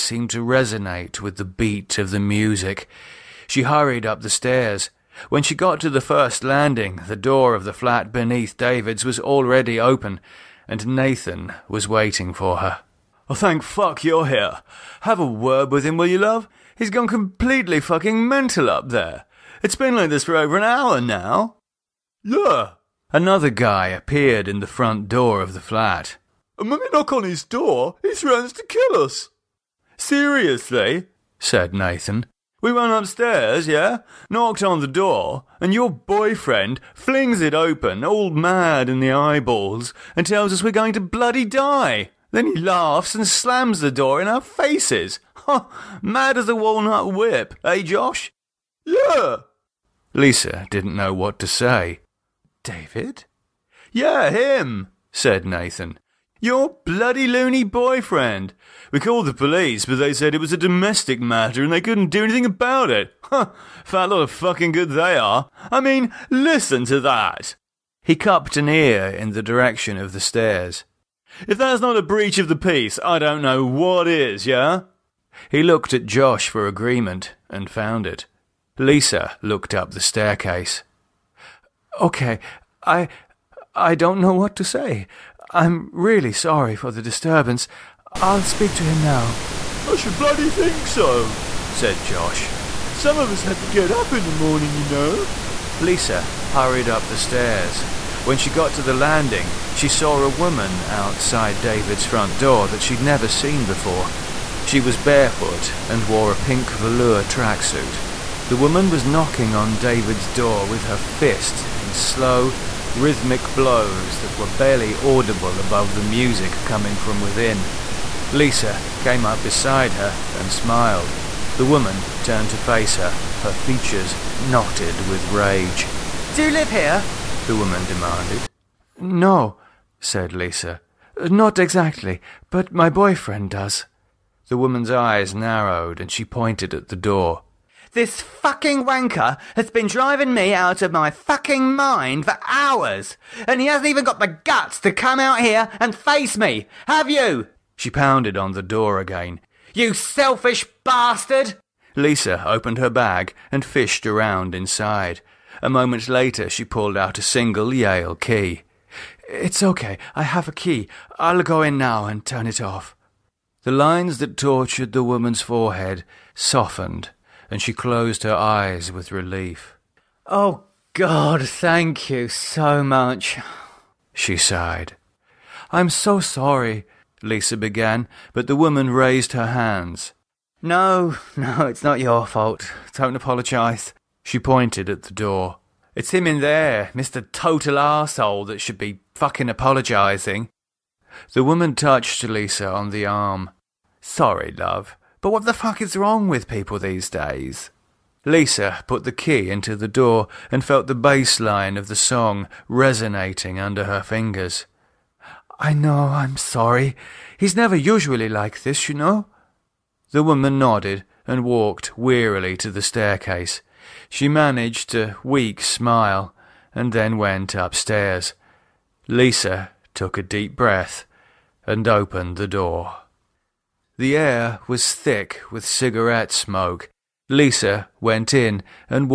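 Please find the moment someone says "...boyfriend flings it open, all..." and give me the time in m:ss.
0:35.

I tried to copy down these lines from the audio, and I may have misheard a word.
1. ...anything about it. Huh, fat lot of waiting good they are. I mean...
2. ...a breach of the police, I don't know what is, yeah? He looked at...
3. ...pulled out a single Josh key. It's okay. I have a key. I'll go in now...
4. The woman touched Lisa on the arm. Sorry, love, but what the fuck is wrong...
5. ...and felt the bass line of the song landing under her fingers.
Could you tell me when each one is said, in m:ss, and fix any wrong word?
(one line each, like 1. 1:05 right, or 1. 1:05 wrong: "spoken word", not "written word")
1. 1:02 wrong: "fucking", not "waiting"
2. 1:11 wrong: "peace", not "police"
3. 2:36 wrong: "Yale", not "Josh"
4. 3:11 right
5. 3:20 wrong: "resonating", not "landing".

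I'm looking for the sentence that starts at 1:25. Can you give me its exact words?
I'm really sorry for the disturbance.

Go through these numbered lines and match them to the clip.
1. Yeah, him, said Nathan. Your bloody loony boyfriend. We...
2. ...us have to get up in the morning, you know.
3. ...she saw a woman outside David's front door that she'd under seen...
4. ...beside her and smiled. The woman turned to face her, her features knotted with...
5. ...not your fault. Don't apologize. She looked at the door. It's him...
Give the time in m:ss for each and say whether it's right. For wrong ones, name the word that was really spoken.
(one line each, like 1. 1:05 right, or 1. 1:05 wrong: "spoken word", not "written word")
1. 0:53 right
2. 1:33 right
3. 1:39 wrong: "never", not "under"
4. 1:59 right
5. 3:01 wrong: "pointed", not "looked".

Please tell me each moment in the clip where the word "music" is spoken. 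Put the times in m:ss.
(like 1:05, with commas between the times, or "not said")
0:02, 1:56.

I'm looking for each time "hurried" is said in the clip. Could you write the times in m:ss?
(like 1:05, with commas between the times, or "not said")
0:03, 1:36.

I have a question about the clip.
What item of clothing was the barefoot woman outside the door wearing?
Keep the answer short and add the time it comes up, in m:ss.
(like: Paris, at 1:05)
Pink velour tracksuit, at 1:46.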